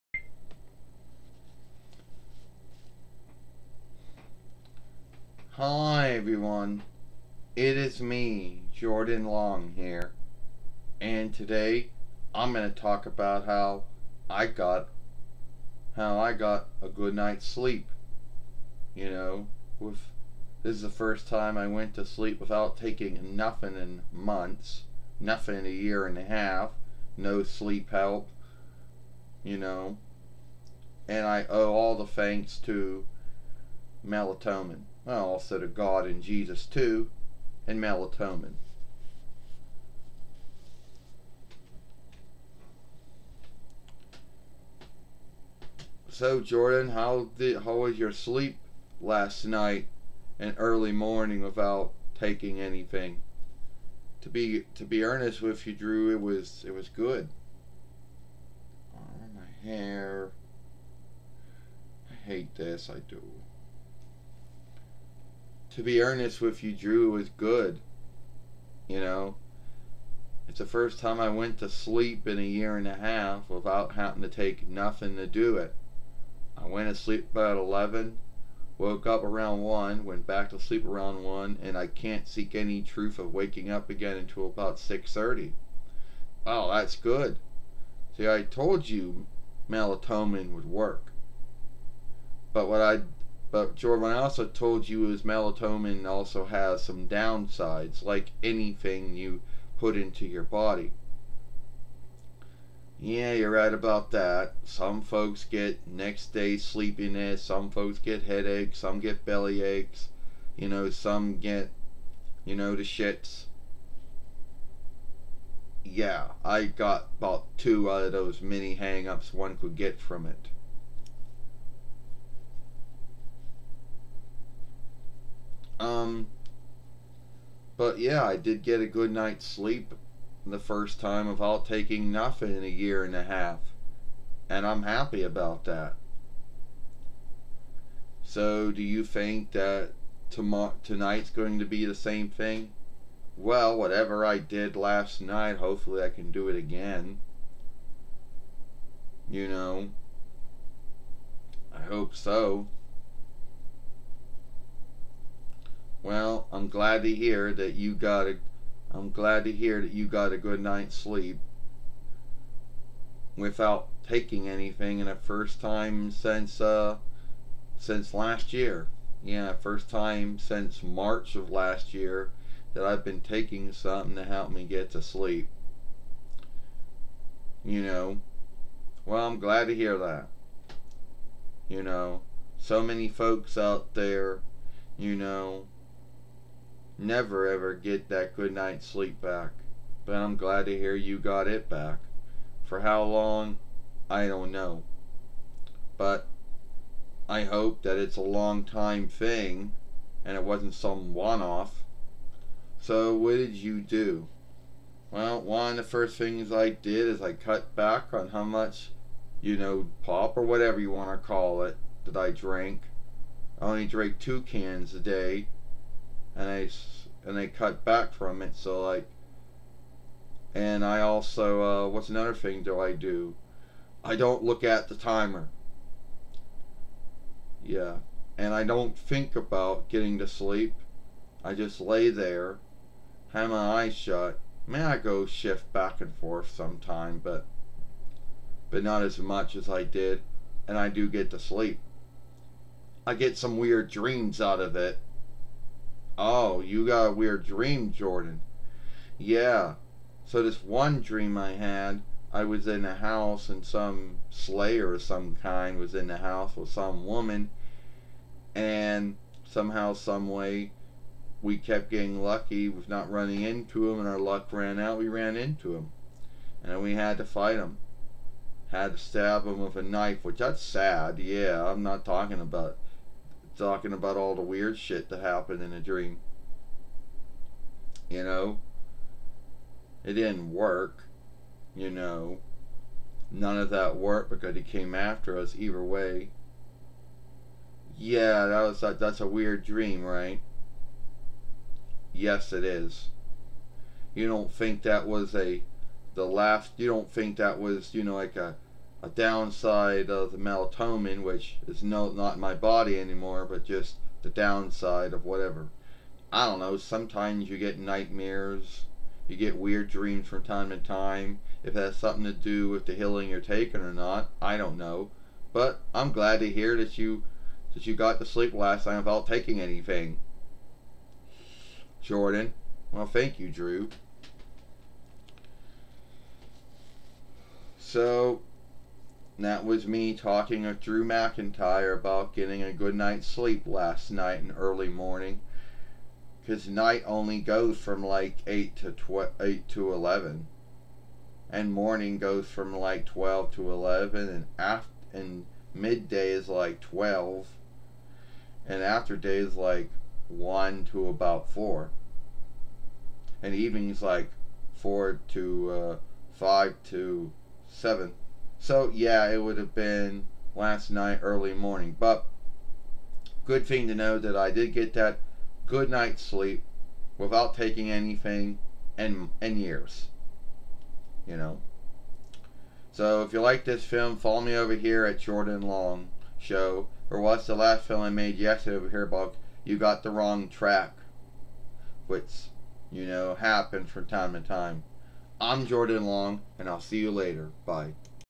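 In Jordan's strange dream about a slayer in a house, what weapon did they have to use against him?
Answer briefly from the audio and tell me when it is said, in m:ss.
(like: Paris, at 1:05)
A knife, at 4:29.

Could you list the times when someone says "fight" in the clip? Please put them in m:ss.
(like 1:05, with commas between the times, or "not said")
4:27.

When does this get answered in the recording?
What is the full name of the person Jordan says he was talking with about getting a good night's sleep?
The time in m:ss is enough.
5:30.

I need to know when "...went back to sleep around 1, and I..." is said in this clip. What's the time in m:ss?
1:20.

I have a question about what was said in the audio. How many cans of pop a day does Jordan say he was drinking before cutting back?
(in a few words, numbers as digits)
2 cans.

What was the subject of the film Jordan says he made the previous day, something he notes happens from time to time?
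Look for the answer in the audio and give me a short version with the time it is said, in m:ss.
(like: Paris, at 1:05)
The wrong track, at 6:20.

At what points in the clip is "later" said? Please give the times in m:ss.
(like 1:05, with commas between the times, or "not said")
6:27.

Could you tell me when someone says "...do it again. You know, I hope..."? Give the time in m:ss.
2:26.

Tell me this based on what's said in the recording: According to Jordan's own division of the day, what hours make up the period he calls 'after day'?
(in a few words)
1 to about 4.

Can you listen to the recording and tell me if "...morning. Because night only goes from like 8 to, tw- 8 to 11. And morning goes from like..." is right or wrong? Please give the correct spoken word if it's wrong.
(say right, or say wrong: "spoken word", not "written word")
right.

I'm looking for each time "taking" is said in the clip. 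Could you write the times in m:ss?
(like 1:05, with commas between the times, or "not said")
0:22, 0:52, 2:11, 2:44, 2:53, 5:13, 5:19, 6:07.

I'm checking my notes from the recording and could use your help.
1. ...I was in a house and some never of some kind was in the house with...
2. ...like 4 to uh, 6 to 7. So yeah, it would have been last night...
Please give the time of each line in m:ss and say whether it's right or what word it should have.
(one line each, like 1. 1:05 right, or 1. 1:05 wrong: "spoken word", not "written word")
1. 4:12 wrong: "slayer", not "never"
2. 5:54 wrong: "5", not "6".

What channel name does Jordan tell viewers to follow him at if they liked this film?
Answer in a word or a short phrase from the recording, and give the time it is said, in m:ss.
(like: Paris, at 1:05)
Jordan Long Show, at 6:15.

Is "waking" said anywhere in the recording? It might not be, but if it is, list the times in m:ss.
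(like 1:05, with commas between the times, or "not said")
1:23.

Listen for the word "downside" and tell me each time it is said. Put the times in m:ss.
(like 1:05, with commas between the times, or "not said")
1:37, 4:59, 5:04.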